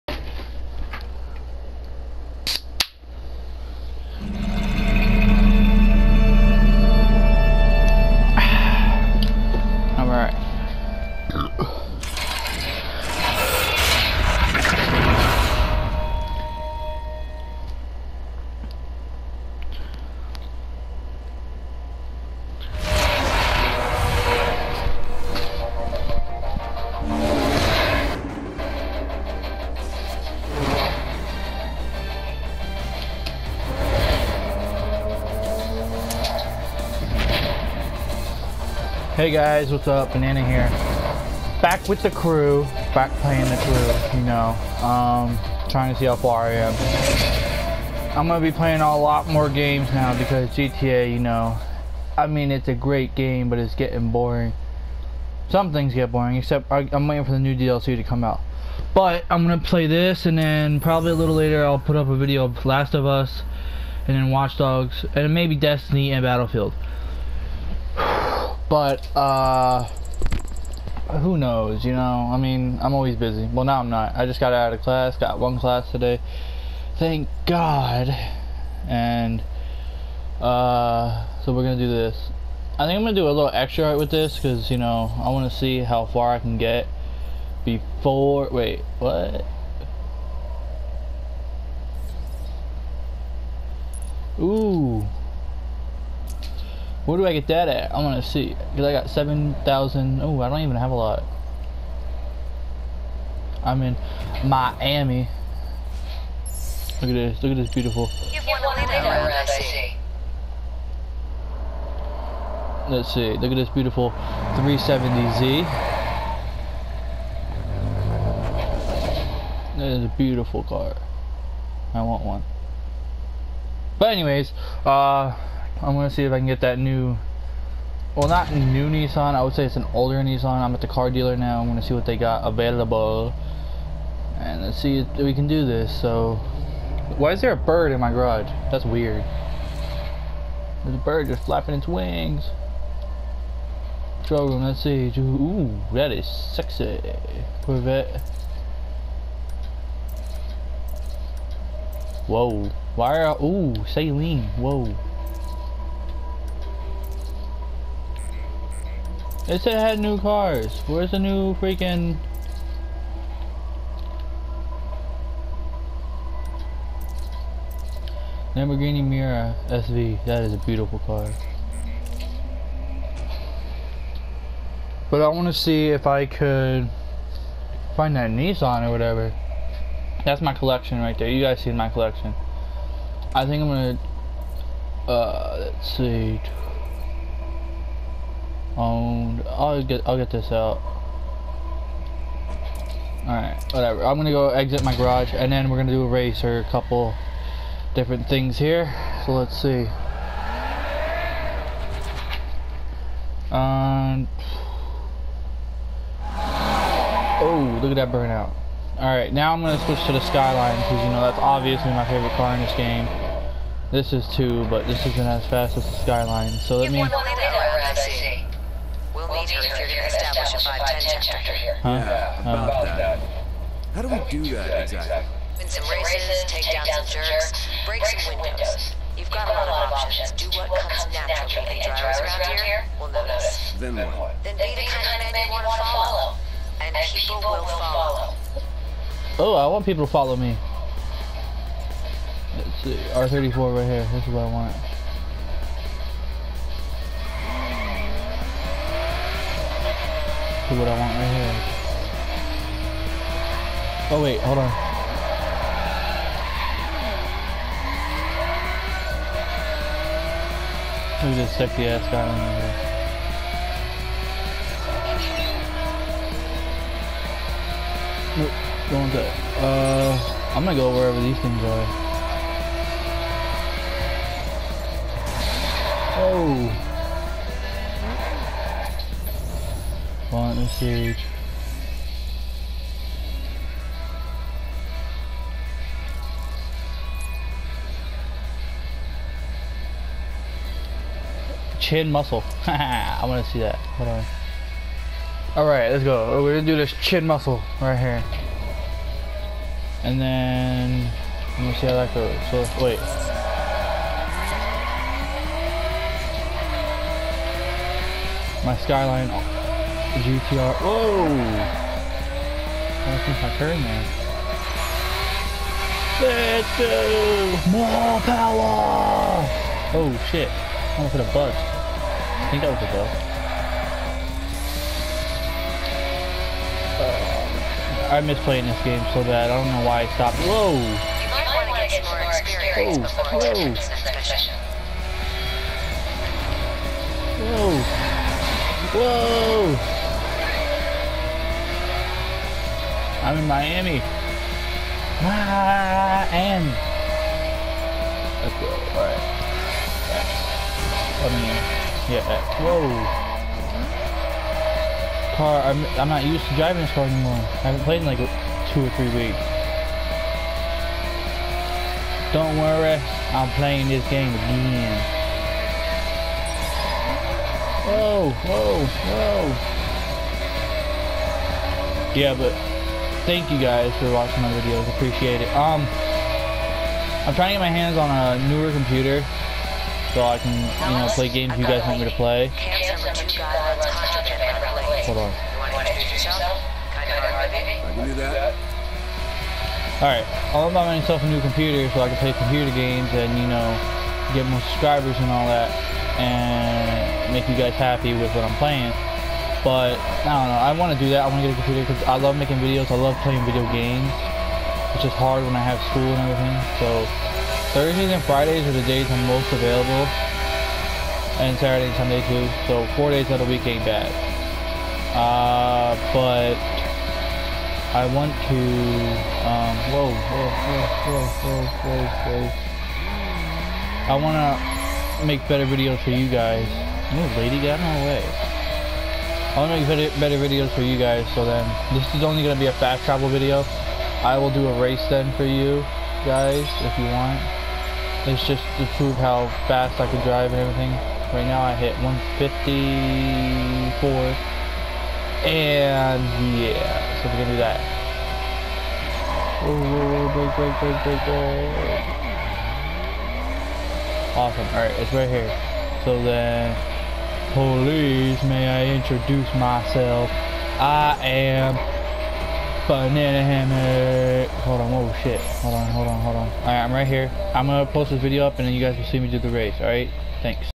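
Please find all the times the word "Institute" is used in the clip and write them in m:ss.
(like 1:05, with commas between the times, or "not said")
not said.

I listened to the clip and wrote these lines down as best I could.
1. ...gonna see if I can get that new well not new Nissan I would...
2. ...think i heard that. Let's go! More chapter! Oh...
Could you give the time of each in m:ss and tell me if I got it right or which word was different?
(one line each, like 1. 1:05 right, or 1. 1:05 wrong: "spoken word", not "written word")
1. 2:05 right
2. 5:13 wrong: "power", not "chapter".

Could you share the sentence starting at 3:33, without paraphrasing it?
This is two, but this isn't as fast as the skyline.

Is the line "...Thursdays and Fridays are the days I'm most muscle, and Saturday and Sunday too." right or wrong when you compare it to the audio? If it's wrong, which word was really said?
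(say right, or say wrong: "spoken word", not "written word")
wrong: "available", not "muscle".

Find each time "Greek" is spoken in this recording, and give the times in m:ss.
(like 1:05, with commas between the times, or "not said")
not said.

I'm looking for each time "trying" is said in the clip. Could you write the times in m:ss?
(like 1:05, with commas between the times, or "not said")
0:45, 6:17.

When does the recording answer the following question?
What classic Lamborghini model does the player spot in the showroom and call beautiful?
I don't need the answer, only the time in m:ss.
2:48.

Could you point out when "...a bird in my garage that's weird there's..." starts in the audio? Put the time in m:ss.
2:17.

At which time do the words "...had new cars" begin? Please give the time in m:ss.
2:39.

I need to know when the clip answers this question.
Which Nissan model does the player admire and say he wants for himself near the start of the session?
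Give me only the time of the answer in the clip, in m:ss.
1:54.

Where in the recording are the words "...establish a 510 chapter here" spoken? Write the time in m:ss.
3:40.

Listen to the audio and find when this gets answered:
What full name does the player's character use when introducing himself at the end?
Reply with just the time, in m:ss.
7:42.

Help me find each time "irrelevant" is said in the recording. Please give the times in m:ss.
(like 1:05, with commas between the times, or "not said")
not said.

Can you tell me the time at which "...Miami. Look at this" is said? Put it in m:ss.
1:44.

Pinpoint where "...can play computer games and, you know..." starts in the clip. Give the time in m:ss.
6:32.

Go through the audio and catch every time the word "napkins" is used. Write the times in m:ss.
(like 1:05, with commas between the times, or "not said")
not said.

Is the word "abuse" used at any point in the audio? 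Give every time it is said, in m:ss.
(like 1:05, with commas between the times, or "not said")
not said.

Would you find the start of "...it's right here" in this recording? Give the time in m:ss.
7:34.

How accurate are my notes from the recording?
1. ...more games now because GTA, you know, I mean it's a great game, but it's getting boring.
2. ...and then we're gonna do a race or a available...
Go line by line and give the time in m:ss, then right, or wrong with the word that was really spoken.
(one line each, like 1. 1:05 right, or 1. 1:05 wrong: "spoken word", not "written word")
1. 0:49 right
2. 3:15 wrong: "couple", not "available".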